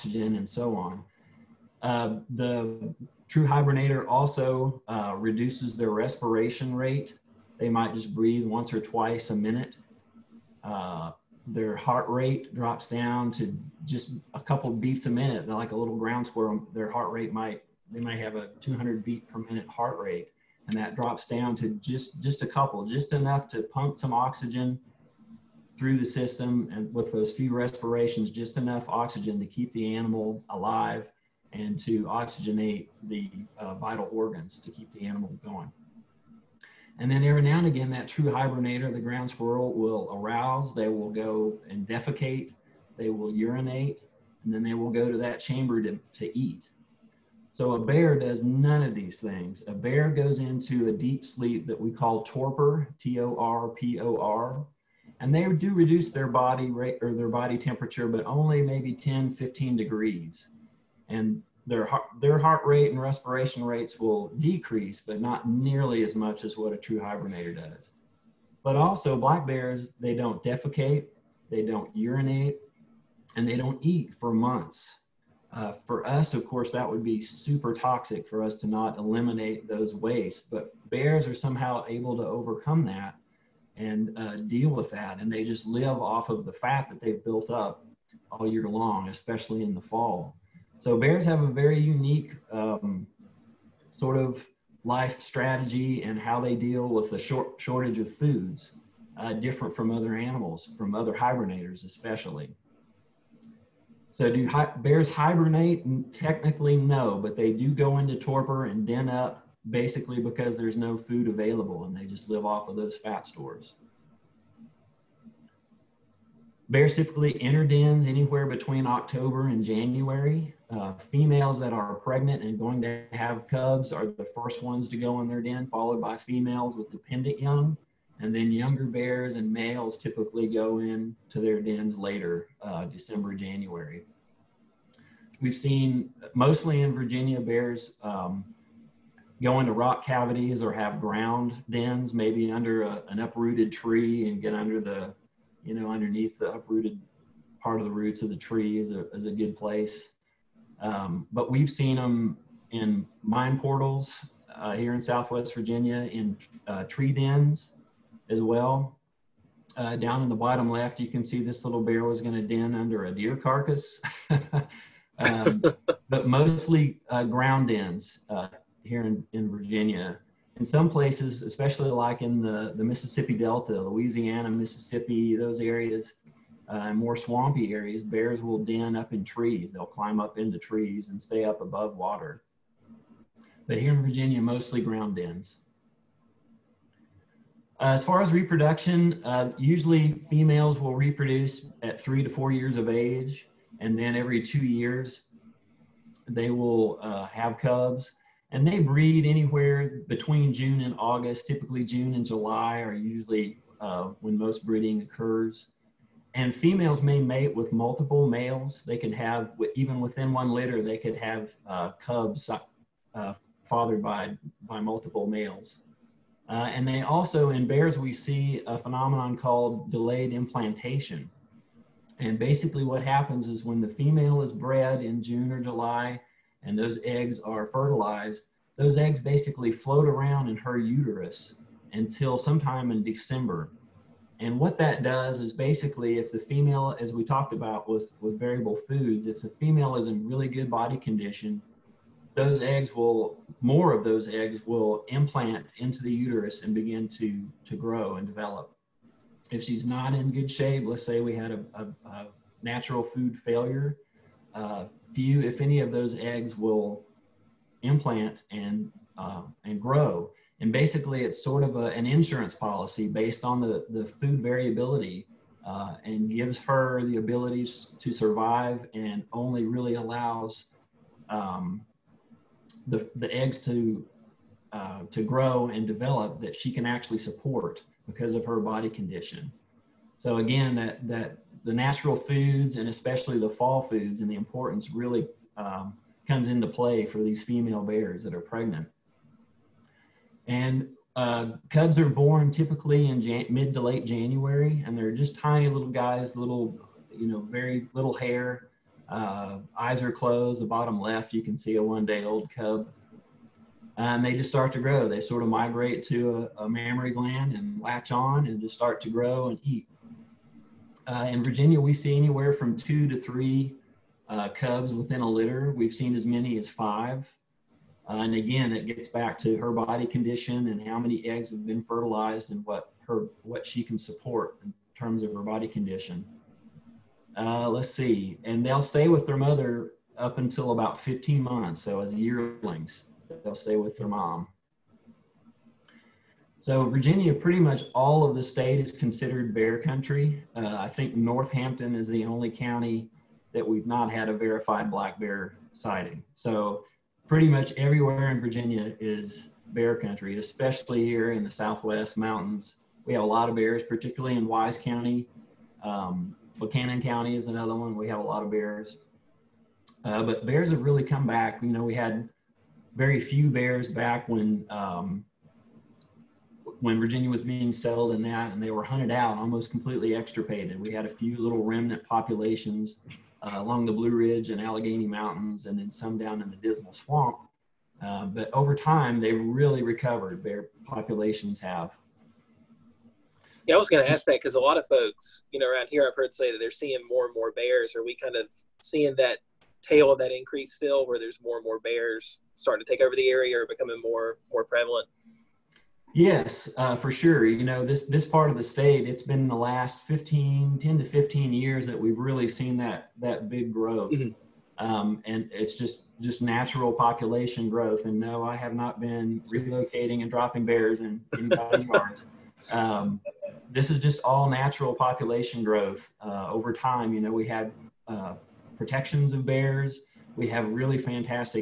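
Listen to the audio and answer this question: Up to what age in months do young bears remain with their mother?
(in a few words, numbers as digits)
15 months.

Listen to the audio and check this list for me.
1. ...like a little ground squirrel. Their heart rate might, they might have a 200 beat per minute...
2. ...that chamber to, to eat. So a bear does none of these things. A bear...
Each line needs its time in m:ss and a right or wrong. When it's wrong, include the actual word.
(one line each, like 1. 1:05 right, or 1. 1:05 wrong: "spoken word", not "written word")
1. 0:15 right
2. 0:45 right.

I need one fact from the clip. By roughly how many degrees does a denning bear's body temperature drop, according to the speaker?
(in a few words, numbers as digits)
10 to 15 degrees.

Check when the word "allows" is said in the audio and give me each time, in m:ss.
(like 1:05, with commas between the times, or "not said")
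4:29.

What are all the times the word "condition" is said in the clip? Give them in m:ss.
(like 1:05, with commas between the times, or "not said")
4:00, 4:38, 5:20, 5:25.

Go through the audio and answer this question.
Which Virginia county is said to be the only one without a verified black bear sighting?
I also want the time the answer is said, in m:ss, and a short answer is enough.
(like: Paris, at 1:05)
Northampton, at 5:41.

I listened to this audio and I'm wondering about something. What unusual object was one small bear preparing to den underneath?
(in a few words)
a deer carcass.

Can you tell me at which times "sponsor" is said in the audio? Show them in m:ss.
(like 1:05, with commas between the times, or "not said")
not said.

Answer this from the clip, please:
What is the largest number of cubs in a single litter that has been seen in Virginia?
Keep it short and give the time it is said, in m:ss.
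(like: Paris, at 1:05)
5, at 5:16.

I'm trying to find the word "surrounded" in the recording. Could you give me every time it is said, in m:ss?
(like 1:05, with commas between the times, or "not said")
not said.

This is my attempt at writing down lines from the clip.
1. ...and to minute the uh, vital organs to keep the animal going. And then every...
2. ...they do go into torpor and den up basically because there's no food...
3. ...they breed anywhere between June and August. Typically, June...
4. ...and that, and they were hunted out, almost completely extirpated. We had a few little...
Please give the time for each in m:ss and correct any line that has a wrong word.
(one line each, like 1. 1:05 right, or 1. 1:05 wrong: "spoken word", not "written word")
1. 0:31 wrong: "oxygenate", not "minute"
2. 1:47 right
3. 3:18 right
4. 6:08 right.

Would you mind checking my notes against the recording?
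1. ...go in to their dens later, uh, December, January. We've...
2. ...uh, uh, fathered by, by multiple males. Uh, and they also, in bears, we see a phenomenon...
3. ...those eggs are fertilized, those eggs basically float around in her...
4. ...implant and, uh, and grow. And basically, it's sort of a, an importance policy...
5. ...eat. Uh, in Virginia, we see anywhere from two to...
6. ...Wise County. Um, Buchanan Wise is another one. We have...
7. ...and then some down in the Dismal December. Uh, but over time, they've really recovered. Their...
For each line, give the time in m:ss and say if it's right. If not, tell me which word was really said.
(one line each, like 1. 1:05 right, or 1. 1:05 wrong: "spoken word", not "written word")
1. 2:10 right
2. 3:32 right
3. 3:46 right
4. 4:17 wrong: "insurance", not "importance"
5. 5:09 right
6. 5:54 wrong: "County", not "Wise"
7. 6:15 wrong: "Swamp", not "December".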